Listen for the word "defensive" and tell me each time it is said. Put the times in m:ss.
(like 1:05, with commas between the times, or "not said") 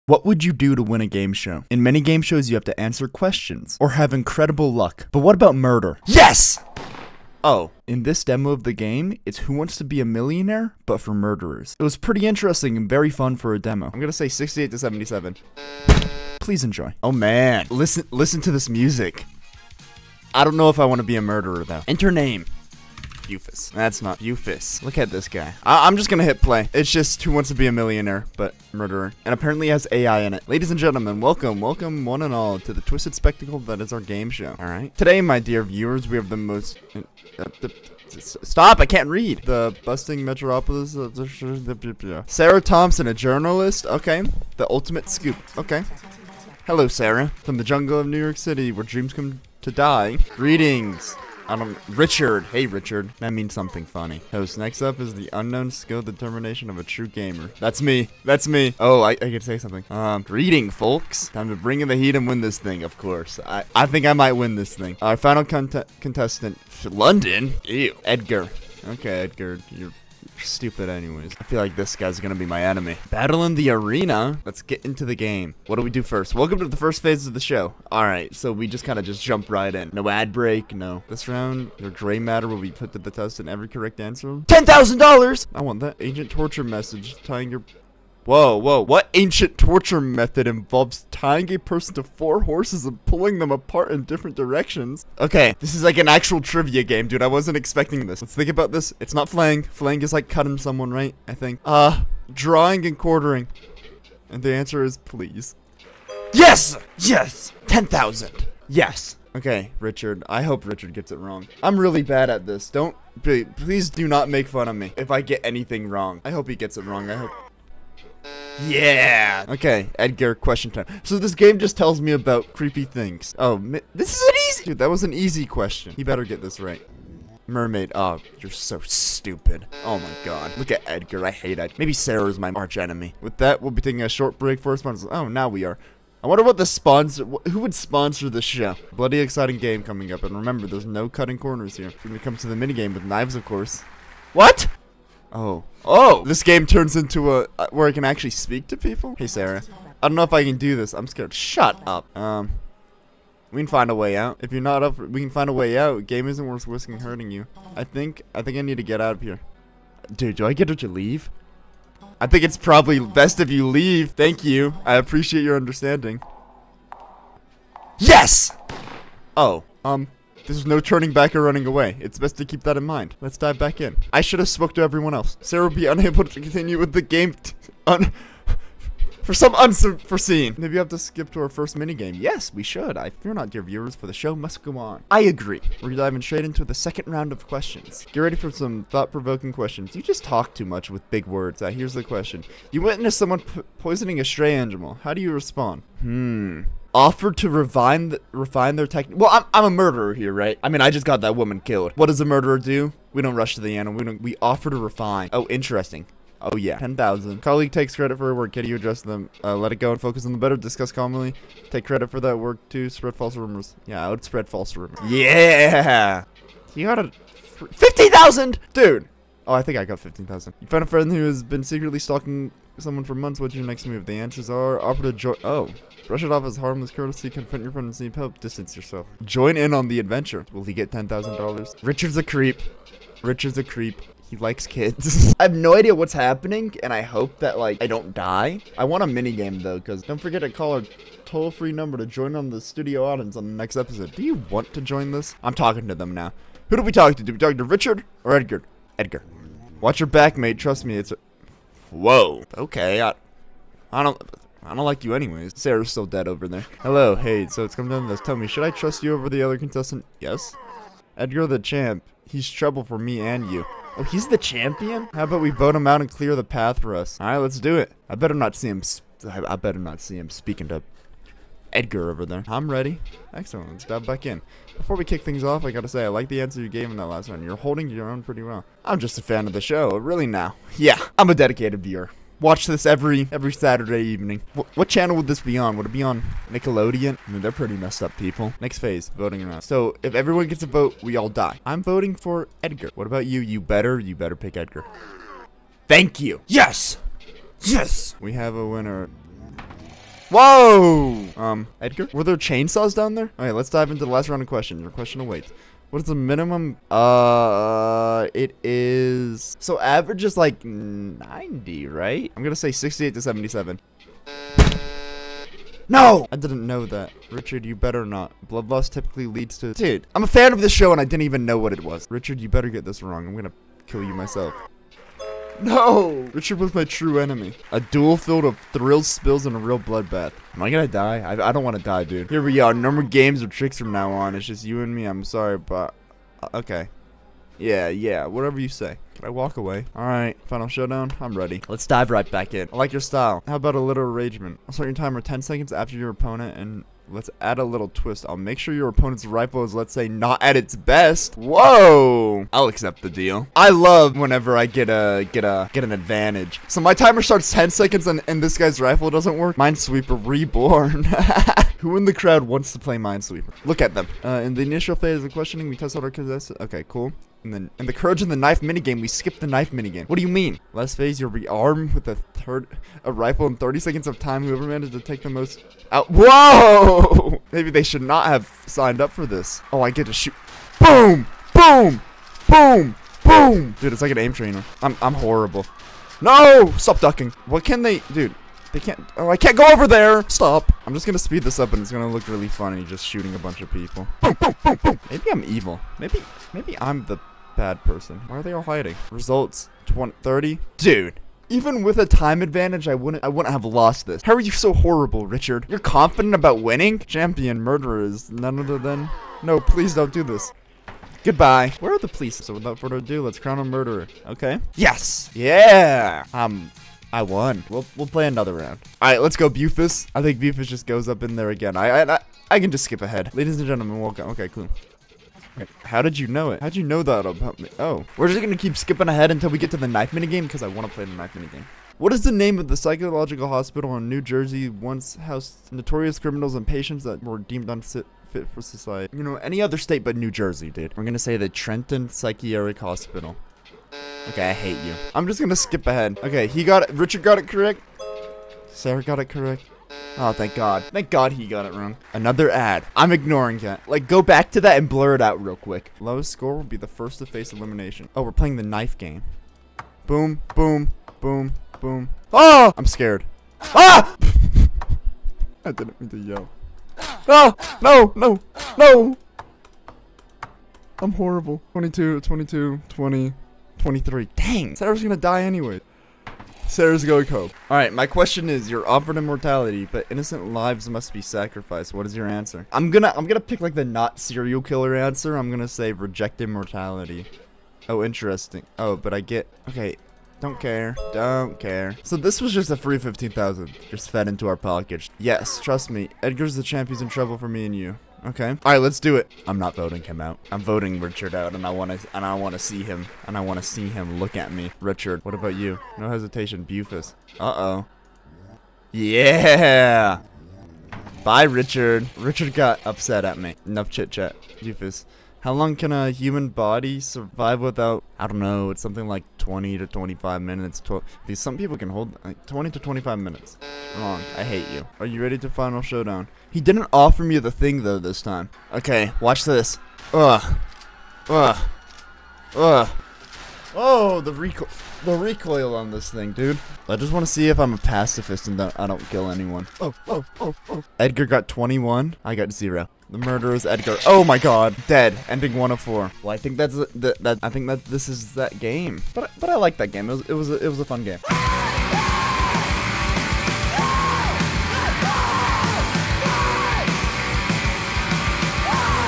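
not said.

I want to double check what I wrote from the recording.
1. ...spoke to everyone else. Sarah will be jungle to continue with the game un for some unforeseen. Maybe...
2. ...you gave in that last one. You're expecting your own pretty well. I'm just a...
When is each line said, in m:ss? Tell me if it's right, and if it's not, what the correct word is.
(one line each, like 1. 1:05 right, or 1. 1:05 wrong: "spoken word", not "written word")
1. 2:54 wrong: "unable", not "jungle"
2. 4:36 wrong: "holding", not "expecting".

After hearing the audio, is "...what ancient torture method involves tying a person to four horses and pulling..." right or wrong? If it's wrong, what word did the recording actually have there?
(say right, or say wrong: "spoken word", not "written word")
right.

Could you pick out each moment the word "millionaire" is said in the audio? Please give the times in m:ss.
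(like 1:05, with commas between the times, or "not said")
0:10, 0:27.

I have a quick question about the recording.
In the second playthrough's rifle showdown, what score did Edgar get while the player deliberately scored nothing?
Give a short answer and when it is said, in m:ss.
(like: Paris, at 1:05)
21, at 9:00.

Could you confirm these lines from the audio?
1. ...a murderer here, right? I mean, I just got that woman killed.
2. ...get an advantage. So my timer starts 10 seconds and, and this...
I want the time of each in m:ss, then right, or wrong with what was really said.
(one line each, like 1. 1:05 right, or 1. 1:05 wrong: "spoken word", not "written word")
1. 3:19 right
2. 5:55 right.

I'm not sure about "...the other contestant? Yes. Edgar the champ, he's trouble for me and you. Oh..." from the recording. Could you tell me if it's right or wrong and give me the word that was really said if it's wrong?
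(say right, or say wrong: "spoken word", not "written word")
right.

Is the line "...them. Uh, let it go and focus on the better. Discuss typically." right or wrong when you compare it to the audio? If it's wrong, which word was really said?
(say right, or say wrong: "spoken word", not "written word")
wrong: "calmly", not "typically".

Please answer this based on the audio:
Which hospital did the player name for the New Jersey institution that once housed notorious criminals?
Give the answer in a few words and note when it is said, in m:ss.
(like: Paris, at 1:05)
Trenton Psychiatric Hospital, at 7:21.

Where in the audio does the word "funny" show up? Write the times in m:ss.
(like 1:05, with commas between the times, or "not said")
0:53, 6:32.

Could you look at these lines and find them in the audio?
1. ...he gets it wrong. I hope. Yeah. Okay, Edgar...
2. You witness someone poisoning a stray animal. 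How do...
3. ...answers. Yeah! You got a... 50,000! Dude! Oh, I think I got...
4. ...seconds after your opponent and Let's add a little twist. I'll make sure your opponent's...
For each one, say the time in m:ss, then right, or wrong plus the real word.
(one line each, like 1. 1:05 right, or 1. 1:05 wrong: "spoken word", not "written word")
1. 1:56 right
2. 3:12 right
3. 3:34 wrong: "rumors", not "answers"
4. 5:45 right.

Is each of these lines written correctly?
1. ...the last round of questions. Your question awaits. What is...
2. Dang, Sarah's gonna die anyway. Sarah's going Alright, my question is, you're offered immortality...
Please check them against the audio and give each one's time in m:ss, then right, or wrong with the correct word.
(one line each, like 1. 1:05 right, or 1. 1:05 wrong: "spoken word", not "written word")
1. 5:04 right
2. 7:54 right.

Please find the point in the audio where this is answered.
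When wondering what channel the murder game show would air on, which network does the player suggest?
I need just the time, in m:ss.
4:45.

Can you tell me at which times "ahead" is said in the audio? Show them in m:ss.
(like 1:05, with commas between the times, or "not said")
7:03, 7:09, 7:25.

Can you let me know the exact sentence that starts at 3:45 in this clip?
Oh, brush it off as harmless courtesy, confront your friends, need help, distance yourself.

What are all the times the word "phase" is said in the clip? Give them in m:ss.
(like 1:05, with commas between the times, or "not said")
1:17, 4:48, 6:04, 6:10.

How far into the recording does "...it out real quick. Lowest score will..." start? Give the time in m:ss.
7:35.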